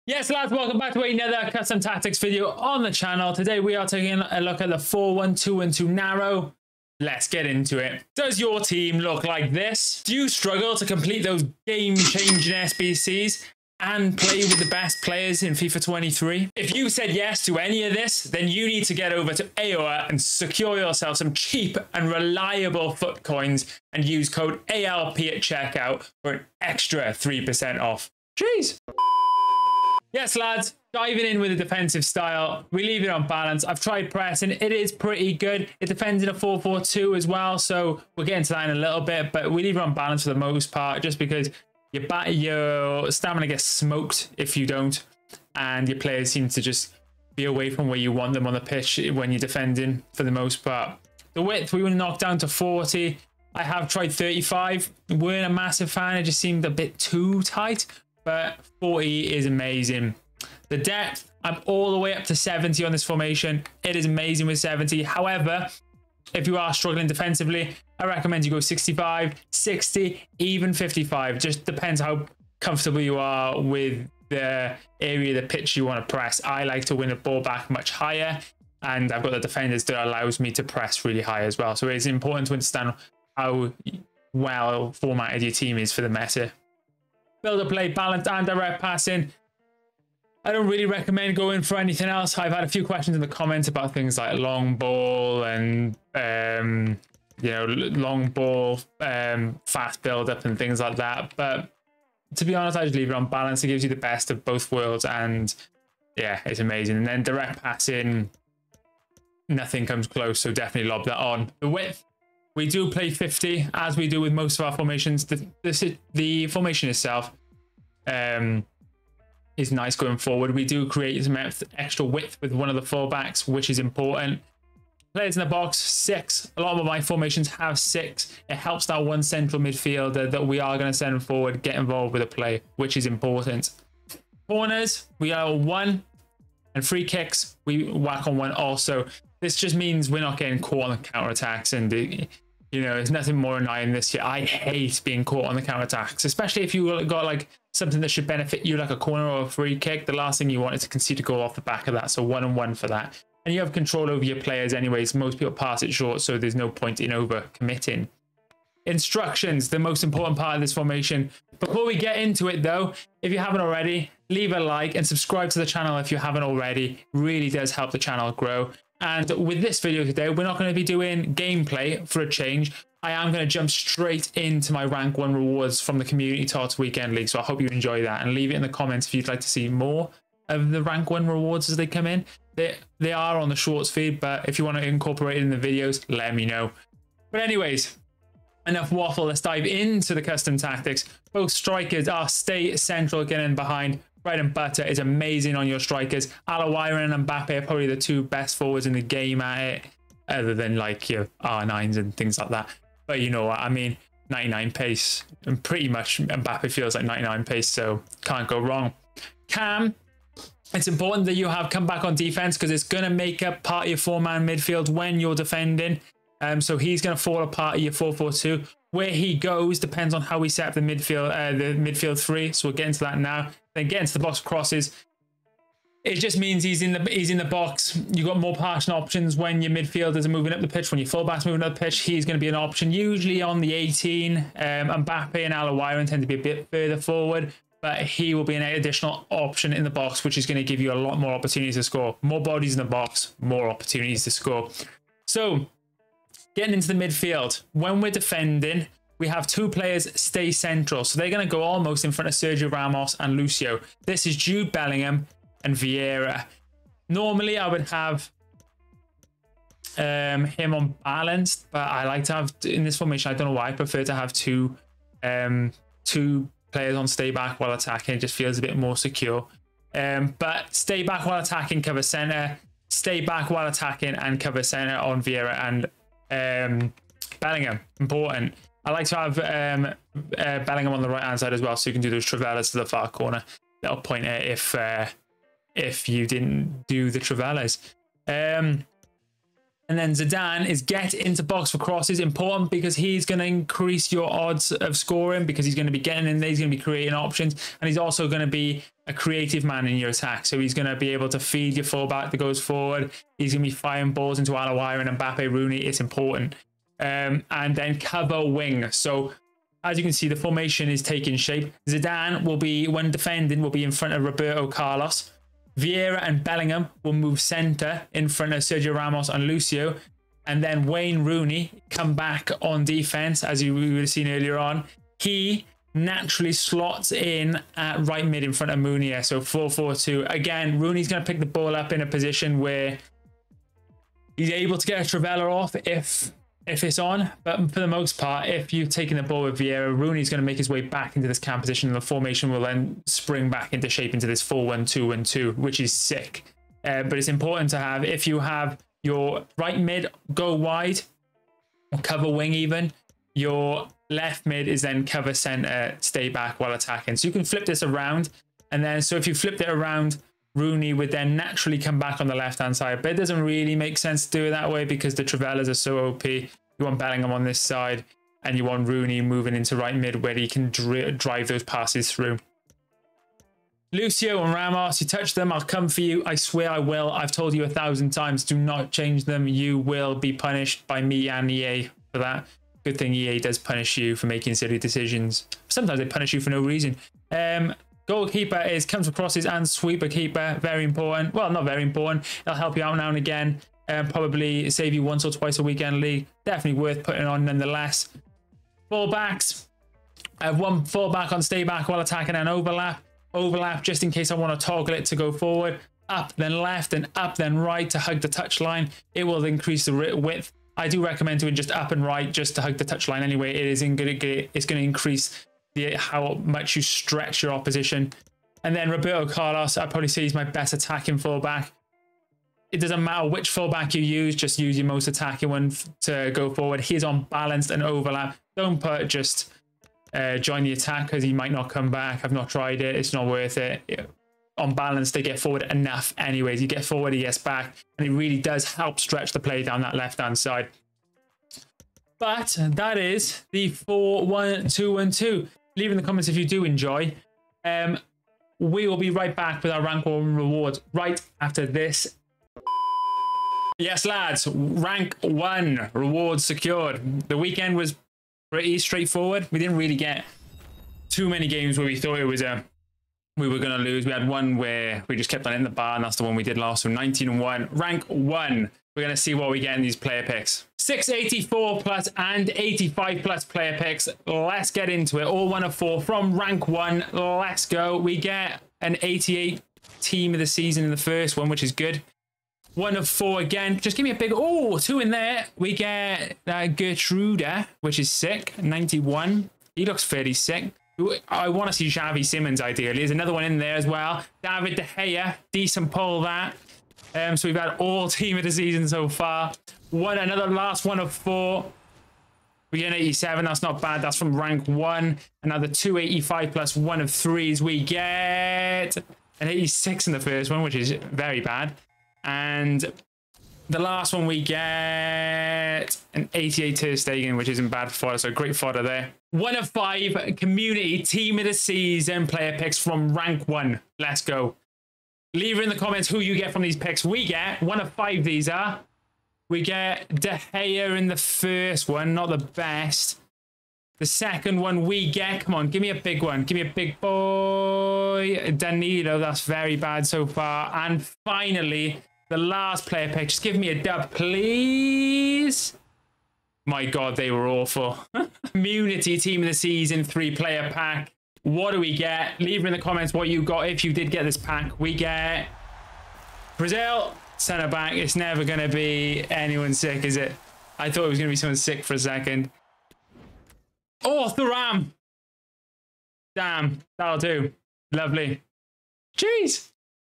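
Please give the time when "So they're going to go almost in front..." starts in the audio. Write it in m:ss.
4:11.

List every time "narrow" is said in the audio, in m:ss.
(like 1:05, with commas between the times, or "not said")
0:05.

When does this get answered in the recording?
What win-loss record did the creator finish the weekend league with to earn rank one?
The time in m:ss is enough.
7:46.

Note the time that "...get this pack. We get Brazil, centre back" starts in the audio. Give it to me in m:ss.
9:14.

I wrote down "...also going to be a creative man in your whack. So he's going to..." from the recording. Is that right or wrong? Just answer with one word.
wrong.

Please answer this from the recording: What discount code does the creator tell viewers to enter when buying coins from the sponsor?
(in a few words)
AYYLP.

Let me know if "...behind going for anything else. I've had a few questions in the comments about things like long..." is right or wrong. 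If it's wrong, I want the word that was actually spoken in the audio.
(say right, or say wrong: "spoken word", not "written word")
wrong: "recommend", not "behind".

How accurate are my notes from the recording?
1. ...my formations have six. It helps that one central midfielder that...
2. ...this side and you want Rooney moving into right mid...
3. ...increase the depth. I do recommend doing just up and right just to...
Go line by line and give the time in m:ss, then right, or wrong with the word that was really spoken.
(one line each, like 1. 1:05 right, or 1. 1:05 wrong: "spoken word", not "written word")
1. 2:06 right
2. 6:07 right
3. 6:49 wrong: "width", not "depth".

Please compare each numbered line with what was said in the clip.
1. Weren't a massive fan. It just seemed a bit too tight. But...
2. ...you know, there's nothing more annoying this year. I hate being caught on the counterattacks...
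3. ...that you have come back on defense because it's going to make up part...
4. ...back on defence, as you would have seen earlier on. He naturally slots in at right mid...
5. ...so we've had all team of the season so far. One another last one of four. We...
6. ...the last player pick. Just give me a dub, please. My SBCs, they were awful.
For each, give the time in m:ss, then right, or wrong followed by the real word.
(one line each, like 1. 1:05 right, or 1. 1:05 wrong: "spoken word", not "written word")
1. 0:55 right
2. 2:21 right
3. 3:31 right
4. 5:22 right
5. 8:17 right
6. 9:02 wrong: "God", not "SBCs".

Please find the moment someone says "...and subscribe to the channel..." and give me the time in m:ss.
2:44.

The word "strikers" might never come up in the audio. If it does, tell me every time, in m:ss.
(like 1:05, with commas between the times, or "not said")
3:11, 3:15.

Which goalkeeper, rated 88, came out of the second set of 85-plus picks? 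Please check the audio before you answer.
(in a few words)
Ter Stegen.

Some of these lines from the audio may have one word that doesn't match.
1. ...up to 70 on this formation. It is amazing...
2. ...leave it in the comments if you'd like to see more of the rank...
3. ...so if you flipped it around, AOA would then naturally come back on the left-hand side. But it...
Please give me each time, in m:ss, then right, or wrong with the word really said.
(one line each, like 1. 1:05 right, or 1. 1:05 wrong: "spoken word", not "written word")
1. 1:02 right
2. 2:58 right
3. 5:59 wrong: "Rooney", not "AOA".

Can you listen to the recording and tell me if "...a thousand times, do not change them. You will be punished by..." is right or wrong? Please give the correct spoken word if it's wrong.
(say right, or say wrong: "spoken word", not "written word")
right.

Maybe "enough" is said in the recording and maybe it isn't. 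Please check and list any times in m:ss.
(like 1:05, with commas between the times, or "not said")
3:08, 7:15.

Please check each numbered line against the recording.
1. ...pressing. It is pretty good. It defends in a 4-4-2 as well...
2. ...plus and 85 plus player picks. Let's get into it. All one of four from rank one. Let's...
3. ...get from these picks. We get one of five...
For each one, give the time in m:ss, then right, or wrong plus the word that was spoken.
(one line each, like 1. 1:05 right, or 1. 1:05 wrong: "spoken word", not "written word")
1. 0:34 right
2. 7:51 right
3. 8:46 right.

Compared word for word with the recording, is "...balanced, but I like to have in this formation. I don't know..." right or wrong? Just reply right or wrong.
right.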